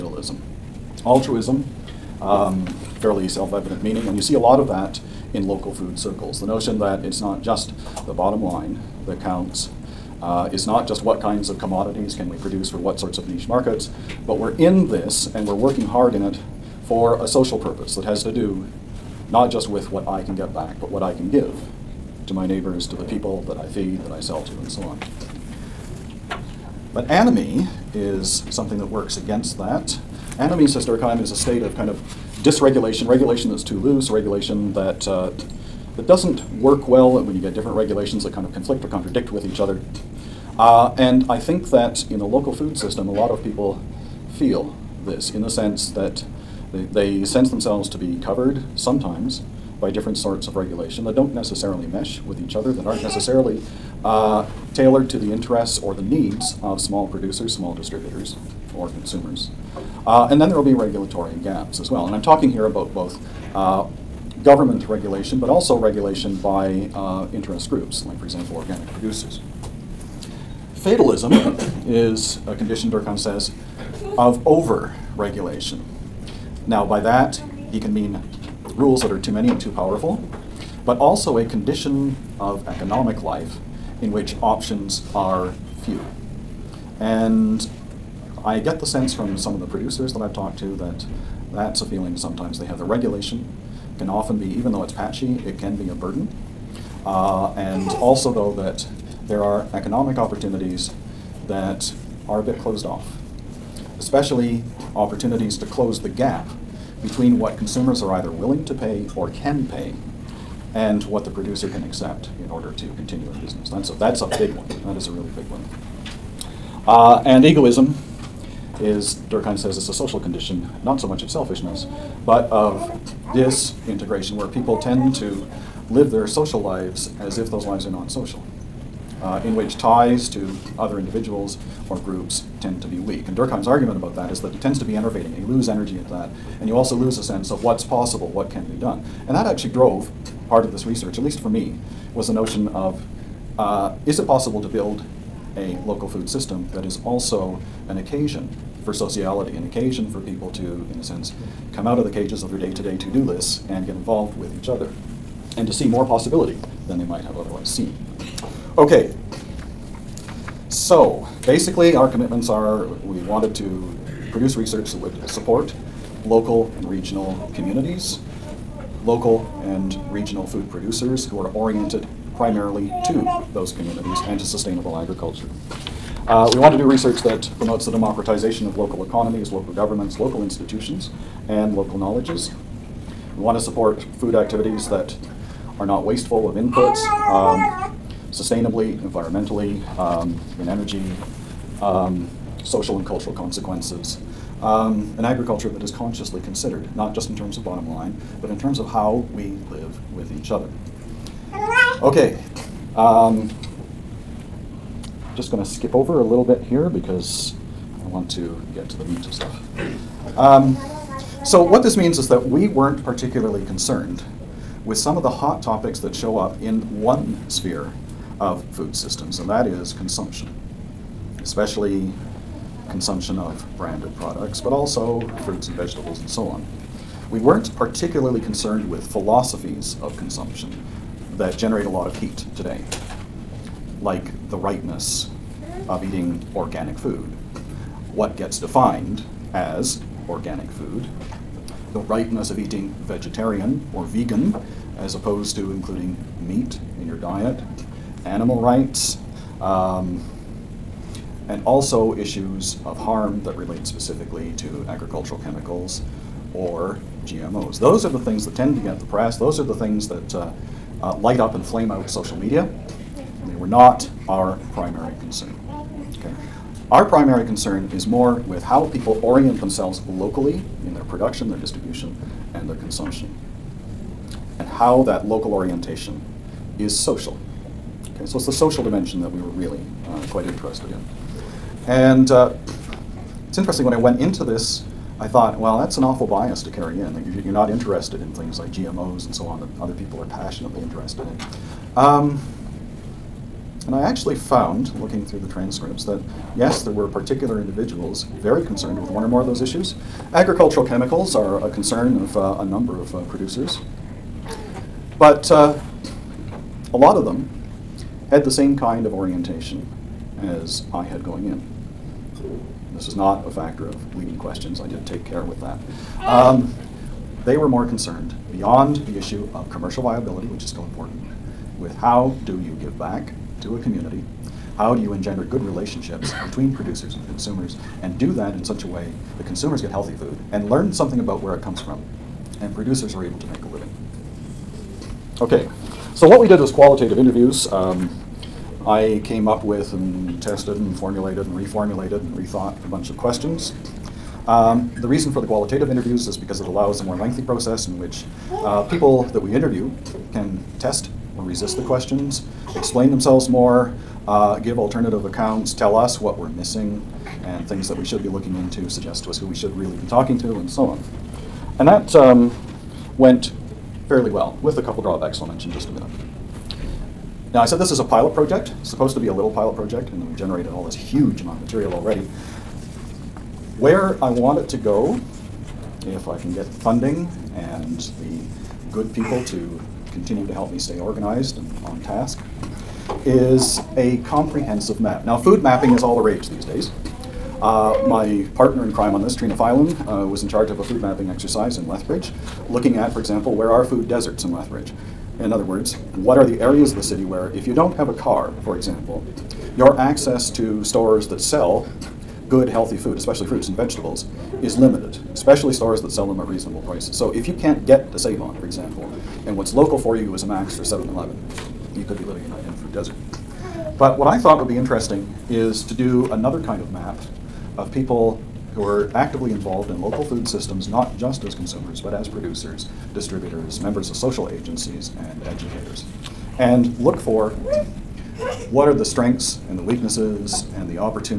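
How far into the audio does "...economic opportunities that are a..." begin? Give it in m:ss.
1:39.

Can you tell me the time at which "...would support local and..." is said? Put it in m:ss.
2:44.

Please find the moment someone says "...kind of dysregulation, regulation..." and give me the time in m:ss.
0:31.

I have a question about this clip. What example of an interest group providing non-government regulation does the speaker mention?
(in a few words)
organic producers.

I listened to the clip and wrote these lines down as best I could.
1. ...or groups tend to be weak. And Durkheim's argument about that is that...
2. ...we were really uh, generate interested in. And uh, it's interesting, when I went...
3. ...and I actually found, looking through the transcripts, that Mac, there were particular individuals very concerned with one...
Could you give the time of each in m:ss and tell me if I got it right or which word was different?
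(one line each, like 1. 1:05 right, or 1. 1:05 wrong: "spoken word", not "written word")
1. 2:11 right
2. 4:39 wrong: "quite", not "generate"
3. 4:53 wrong: "Yes", not "Mac".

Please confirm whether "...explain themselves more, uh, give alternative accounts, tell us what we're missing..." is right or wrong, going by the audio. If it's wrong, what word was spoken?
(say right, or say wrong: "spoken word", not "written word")
right.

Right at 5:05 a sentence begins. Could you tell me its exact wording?
But uh, a lot of them had the same kind of orientation as I had going in.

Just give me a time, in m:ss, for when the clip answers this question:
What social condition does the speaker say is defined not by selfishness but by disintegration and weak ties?
1:57.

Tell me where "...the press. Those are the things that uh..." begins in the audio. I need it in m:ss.
4:18.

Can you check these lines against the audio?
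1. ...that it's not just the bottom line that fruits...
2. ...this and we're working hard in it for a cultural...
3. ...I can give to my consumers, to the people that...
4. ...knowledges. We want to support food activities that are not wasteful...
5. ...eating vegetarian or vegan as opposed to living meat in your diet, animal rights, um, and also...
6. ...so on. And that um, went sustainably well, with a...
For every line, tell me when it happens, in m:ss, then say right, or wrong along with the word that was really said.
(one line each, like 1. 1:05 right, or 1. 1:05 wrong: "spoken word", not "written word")
1. 0:06 wrong: "counts", not "fruits"
2. 0:14 wrong: "social", not "cultural"
3. 0:21 wrong: "neighbors", not "consumers"
4. 3:01 right
5. 4:02 wrong: "including", not "living"
6. 6:00 wrong: "fairly", not "sustainably".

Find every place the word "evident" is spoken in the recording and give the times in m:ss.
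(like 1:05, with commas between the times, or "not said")
0:03.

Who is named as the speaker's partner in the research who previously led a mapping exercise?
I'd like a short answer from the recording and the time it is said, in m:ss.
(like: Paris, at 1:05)
Trina Phelan, at 6:29.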